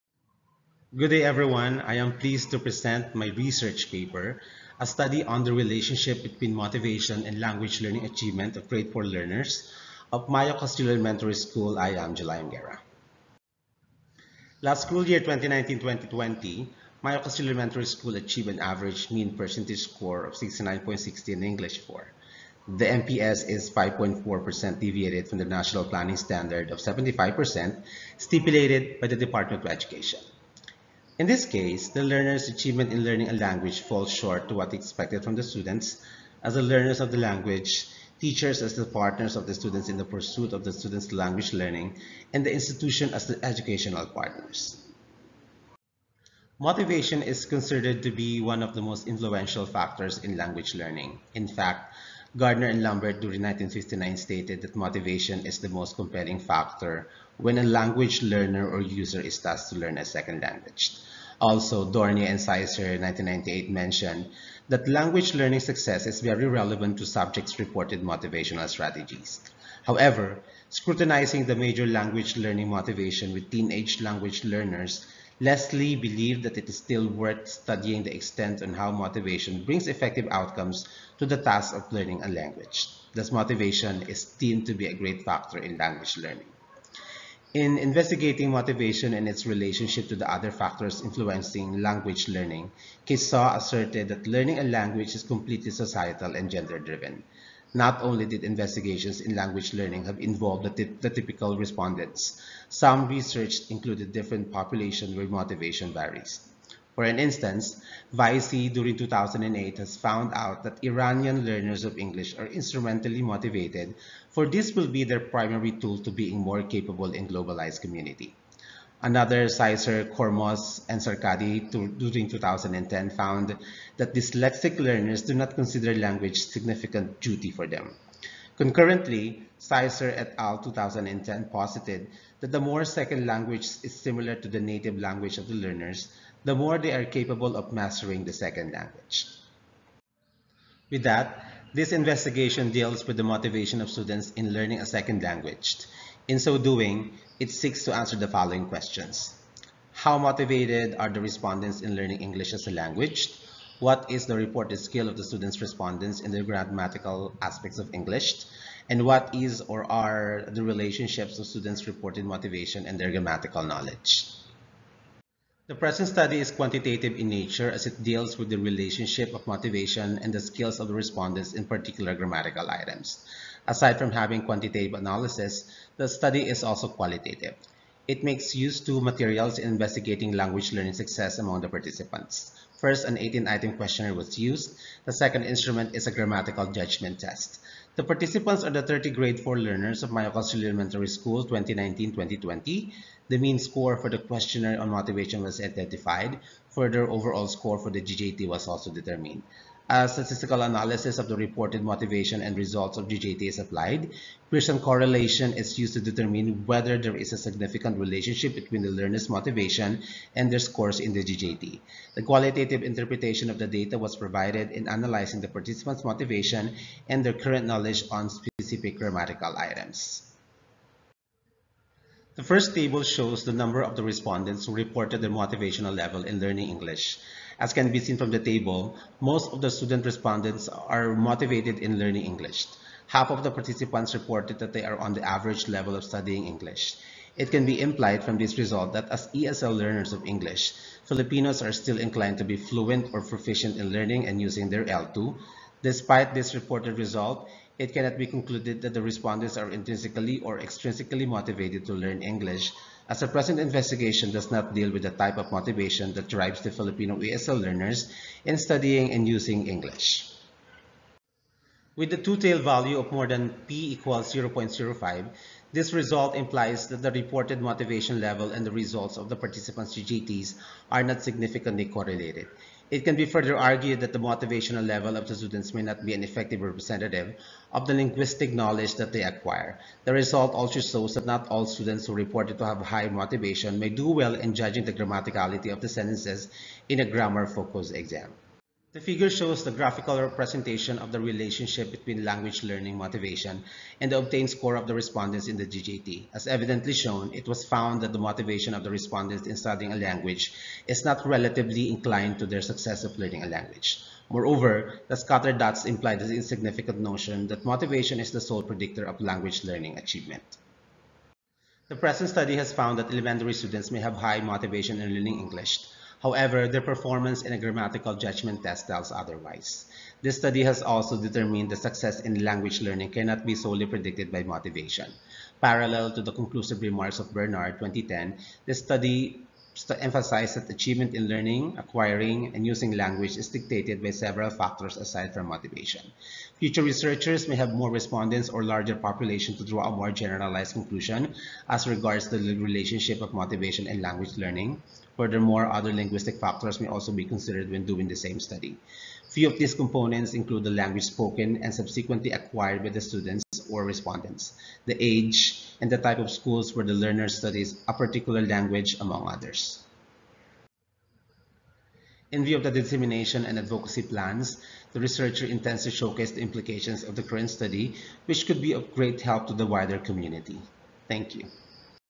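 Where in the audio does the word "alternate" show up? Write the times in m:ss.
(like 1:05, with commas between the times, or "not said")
not said.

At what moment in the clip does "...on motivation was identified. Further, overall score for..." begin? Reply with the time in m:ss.
3:14.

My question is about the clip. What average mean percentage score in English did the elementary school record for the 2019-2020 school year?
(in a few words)
69.60.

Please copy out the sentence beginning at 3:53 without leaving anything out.
Half of the participants reported that they are on the average level of studying English.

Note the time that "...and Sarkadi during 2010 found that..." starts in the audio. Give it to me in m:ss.
2:00.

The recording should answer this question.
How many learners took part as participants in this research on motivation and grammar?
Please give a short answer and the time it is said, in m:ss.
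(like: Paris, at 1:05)
30, at 3:08.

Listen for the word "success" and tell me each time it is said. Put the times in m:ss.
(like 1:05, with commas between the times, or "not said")
1:05, 3:00, 5:02, 5:21.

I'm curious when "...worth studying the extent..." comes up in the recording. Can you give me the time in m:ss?
1:17.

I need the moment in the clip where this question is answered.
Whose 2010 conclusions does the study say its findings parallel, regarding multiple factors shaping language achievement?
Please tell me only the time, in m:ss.
5:27.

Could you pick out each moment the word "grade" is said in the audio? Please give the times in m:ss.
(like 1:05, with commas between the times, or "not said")
0:08, 3:09.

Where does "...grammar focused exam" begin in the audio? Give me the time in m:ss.
4:47.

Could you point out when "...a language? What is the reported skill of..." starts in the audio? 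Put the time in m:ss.
2:32.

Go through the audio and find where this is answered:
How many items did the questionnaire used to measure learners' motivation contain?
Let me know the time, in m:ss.
3:03.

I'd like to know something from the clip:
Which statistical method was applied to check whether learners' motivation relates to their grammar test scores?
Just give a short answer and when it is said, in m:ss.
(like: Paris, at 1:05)
Pearson correlation, at 3:24.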